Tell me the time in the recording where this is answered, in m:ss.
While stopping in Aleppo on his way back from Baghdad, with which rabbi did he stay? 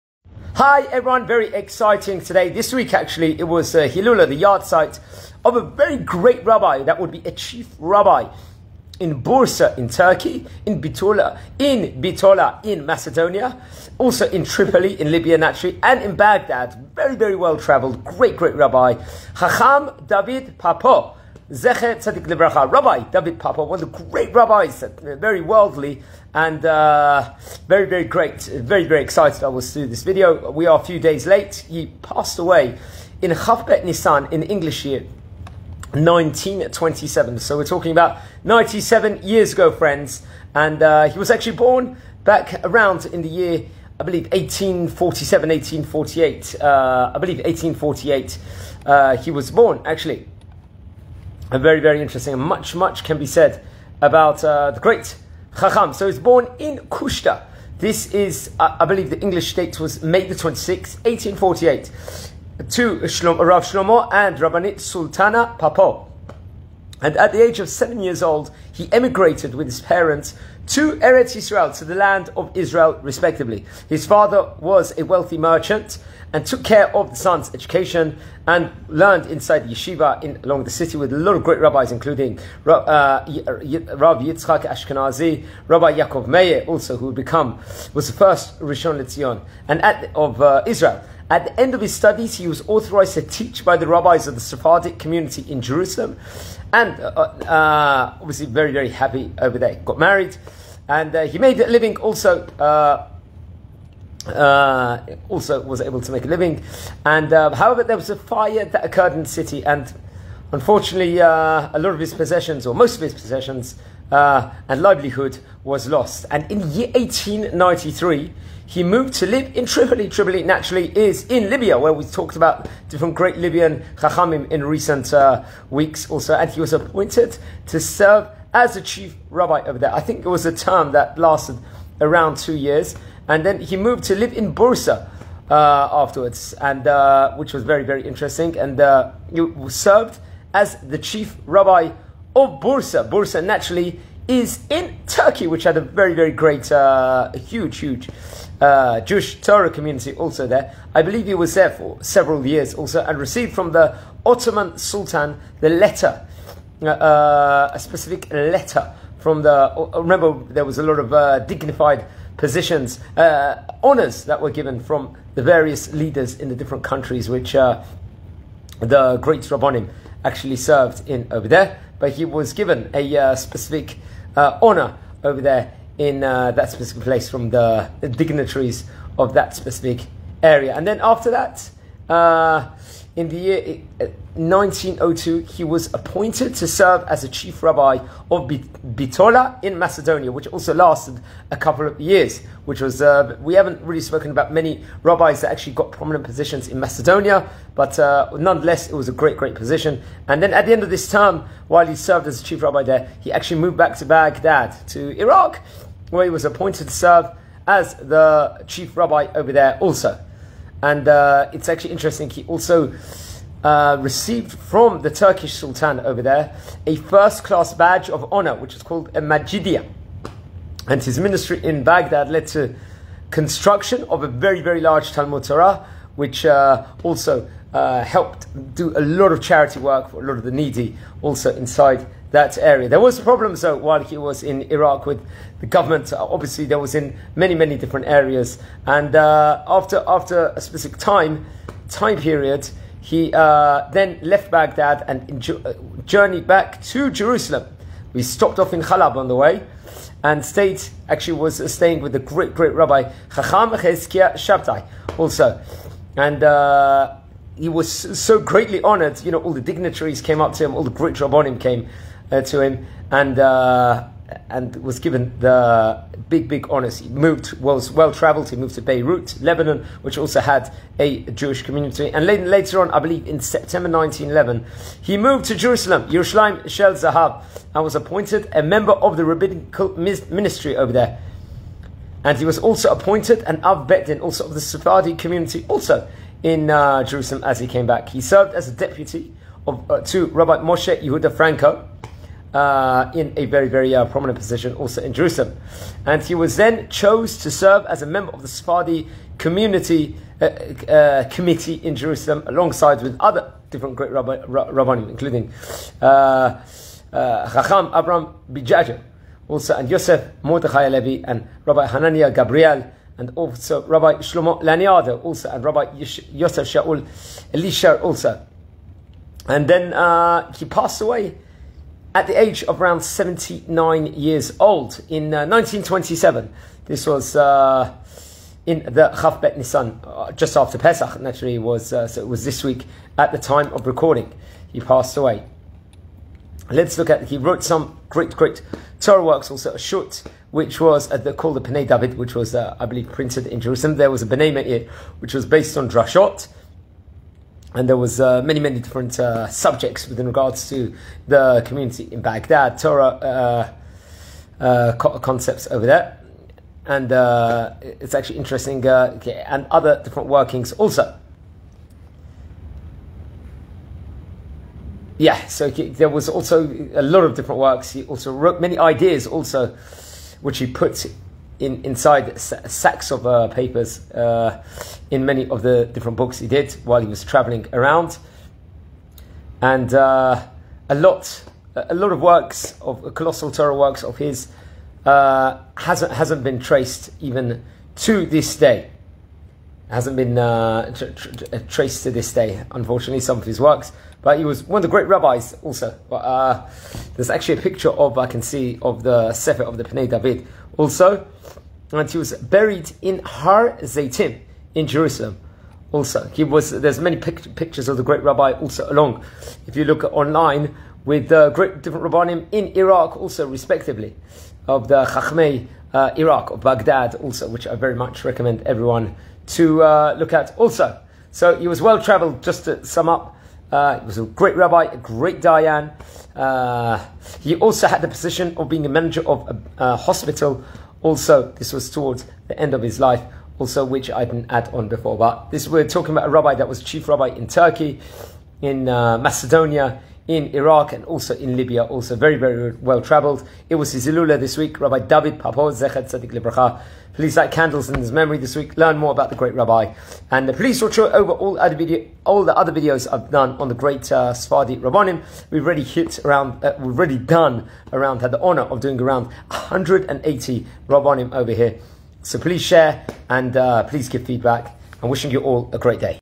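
4:13.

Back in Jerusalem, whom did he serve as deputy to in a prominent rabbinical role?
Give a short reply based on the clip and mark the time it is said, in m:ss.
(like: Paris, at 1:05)
Moshe Yehuda Franco, at 4:50.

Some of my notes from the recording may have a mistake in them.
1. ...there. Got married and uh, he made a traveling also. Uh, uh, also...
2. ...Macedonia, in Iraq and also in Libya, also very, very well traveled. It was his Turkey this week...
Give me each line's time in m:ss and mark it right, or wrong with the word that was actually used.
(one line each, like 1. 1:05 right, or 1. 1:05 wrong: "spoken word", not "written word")
1. 1:39 wrong: "living", not "traveling"
2. 7:19 wrong: "Ilula", not "Turkey".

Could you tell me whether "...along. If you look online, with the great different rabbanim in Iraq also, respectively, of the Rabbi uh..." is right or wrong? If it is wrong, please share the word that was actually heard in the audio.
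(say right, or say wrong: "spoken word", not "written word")
wrong: "Chachmei", not "Rabbi".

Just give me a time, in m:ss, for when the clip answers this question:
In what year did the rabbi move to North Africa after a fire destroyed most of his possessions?
1:56.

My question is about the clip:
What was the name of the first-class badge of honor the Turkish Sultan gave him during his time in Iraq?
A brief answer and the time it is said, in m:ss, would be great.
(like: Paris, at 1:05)
Majidia, at 3:39.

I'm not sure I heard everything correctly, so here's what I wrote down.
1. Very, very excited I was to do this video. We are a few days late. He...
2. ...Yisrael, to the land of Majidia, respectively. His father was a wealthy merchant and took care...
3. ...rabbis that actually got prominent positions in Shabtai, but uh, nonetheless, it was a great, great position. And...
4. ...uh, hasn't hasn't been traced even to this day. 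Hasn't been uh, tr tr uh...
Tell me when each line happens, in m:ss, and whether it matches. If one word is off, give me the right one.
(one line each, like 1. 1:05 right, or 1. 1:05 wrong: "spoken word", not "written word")
1. 0:28 right
2. 1:11 wrong: "Israel", not "Majidia"
3. 3:15 wrong: "Macedonia", not "Shabtai"
4. 6:25 right.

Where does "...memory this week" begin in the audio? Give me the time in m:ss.
7:28.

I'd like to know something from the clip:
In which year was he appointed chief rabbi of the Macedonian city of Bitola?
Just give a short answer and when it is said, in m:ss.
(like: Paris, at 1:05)
1902, at 3:04.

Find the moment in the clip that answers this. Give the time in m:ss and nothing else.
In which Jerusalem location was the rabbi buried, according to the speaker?
6:43.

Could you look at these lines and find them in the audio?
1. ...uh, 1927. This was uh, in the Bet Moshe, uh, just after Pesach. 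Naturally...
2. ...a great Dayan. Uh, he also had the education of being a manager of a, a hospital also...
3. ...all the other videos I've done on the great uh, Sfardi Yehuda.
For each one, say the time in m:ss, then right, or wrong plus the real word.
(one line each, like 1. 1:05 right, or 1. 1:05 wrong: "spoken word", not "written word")
1. 5:25 wrong: "Nisan", not "Moshe"
2. 7:04 wrong: "position", not "education"
3. 7:32 wrong: "Rabbanim", not "Yehuda".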